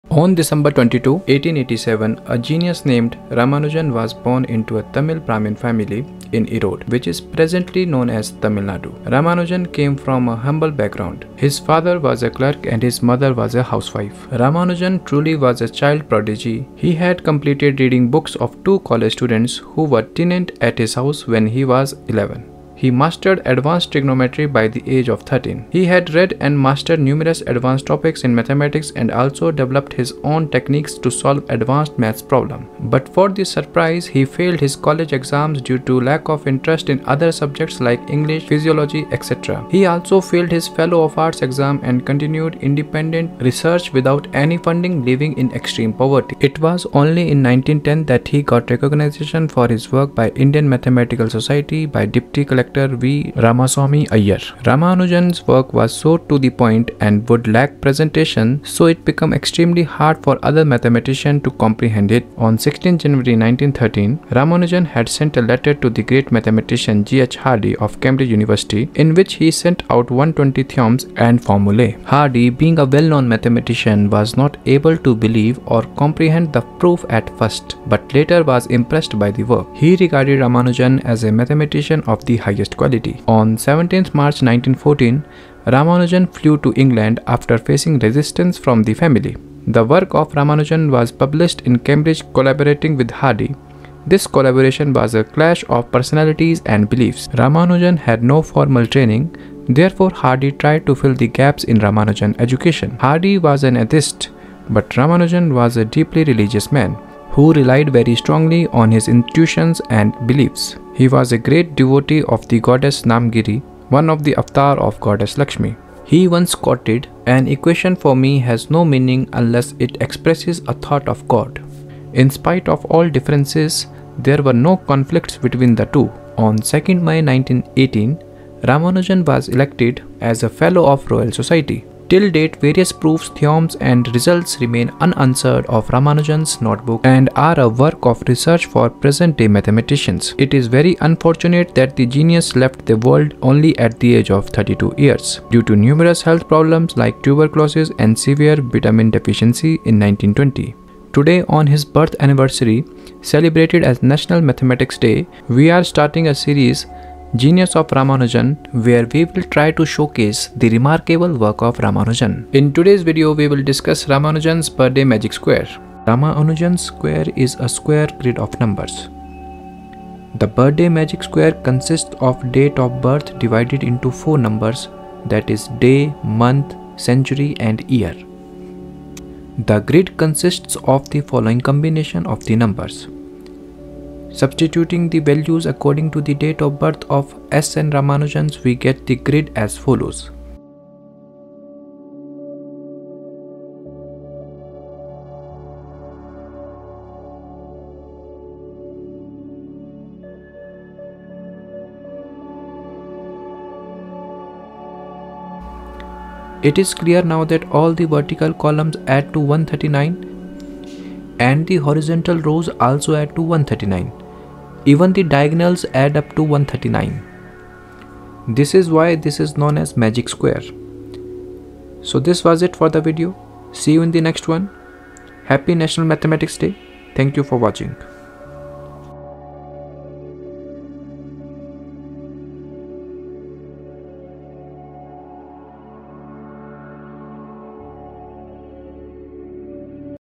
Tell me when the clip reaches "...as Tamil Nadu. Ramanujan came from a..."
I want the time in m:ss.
0:08.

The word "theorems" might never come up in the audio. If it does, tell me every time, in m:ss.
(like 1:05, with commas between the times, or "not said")
1:10, 2:13.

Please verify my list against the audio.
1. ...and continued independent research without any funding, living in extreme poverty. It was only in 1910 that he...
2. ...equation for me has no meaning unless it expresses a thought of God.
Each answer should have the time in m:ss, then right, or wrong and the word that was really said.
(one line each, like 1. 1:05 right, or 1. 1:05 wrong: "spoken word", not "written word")
1. 0:41 right
2. 1:57 right.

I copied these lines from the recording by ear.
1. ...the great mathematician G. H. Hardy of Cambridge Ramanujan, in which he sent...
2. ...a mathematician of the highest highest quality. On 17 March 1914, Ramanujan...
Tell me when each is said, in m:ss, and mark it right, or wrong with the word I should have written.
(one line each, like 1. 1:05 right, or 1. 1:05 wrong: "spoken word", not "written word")
1. 1:05 wrong: "University", not "Ramanujan"
2. 1:21 right.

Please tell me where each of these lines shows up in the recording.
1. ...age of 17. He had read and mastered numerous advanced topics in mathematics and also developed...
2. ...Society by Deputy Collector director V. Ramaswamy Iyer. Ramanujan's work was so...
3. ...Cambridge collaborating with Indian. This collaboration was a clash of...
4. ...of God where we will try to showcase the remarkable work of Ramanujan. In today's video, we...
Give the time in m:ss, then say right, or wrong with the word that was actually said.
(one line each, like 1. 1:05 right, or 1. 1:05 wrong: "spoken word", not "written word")
1. 0:24 wrong: "13", not "17"
2. 0:51 right
3. 1:31 wrong: "Hardy", not "Indian"
4. 2:37 wrong: "Ramanujan", not "God".